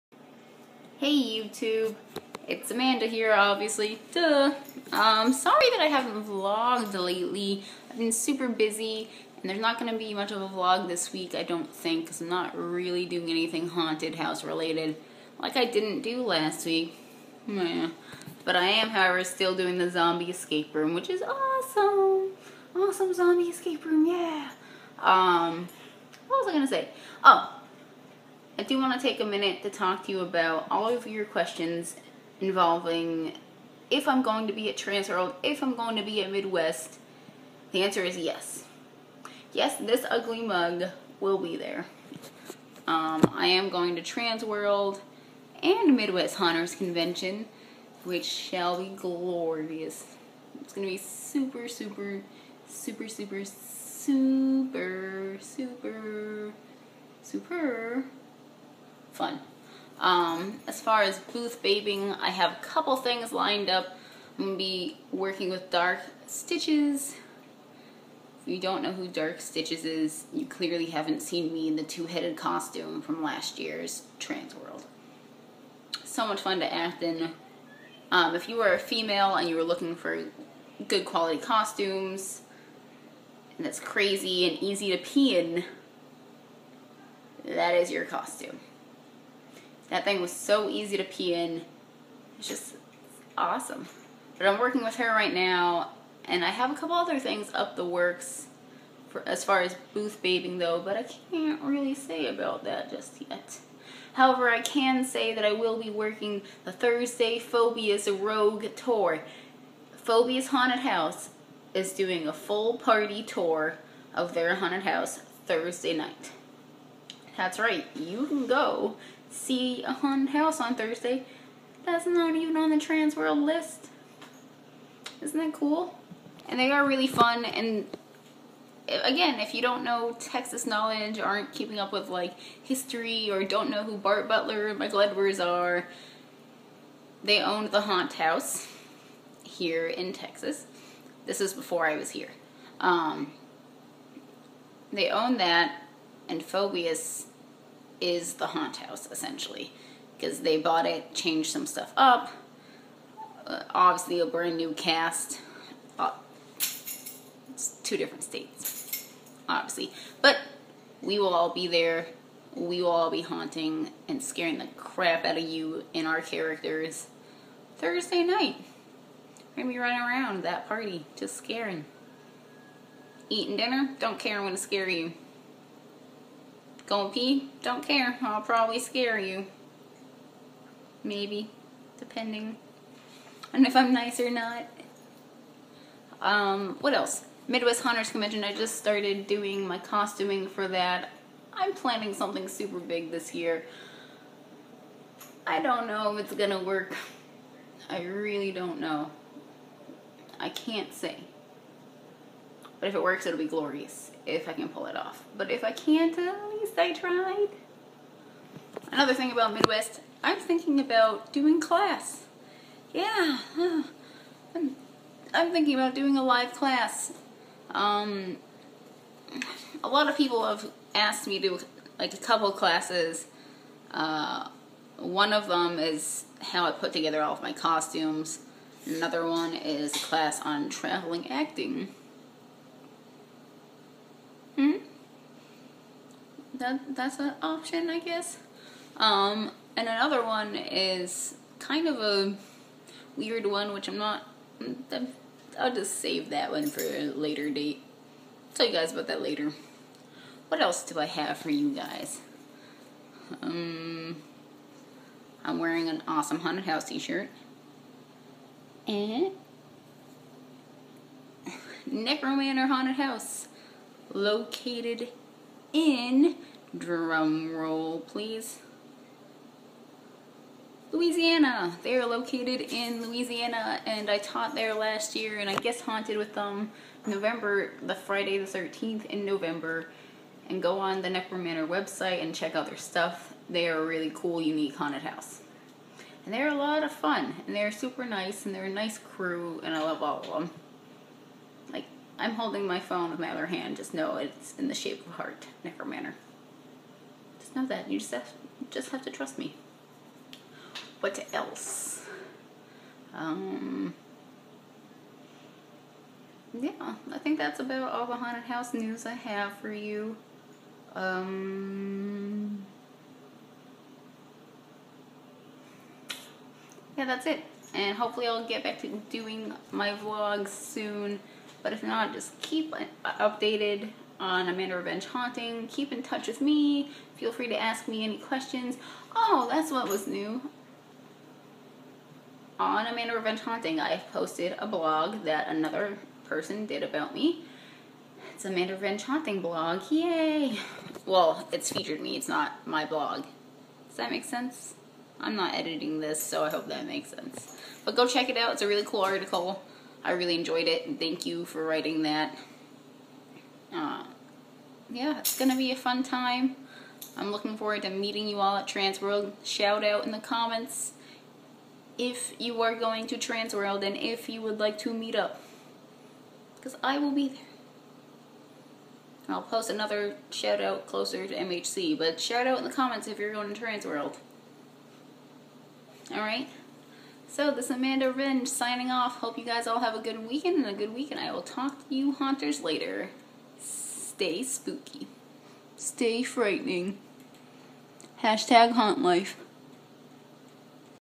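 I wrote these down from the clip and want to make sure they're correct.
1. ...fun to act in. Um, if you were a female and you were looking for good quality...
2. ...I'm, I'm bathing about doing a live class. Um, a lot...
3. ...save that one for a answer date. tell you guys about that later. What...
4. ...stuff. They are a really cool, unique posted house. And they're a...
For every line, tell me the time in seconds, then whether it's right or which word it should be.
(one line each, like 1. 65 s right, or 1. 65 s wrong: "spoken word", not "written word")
1. 76 s right
2. 214 s wrong: "thinking", not "bathing"
3. 245 s wrong: "later", not "answer"
4. 282 s wrong: "haunted", not "posted".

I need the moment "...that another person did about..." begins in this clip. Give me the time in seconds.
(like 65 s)
335 s.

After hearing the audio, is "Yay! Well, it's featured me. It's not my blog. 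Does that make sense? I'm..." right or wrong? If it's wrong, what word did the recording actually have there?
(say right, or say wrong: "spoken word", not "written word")
right.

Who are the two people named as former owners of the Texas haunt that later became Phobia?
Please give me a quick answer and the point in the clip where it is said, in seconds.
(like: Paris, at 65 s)
Bart Butler and Michael Edwards, at 133 s.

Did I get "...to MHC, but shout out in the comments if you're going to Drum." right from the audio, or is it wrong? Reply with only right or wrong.
wrong.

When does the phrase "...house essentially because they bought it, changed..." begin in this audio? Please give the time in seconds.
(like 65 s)
148 s.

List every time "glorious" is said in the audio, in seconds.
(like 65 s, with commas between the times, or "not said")
48 s, 203 s.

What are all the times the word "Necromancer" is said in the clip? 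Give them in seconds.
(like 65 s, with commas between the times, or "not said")
261 s, 281 s, 295 s.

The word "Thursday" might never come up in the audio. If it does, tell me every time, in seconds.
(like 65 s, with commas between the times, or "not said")
106 s, 115 s, 120 s, 167 s.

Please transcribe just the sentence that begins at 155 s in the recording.
Uh, it's two different states, obviously.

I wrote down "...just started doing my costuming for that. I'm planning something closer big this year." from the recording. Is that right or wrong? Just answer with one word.
wrong.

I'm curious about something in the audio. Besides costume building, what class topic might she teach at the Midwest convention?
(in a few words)
Traveling acting.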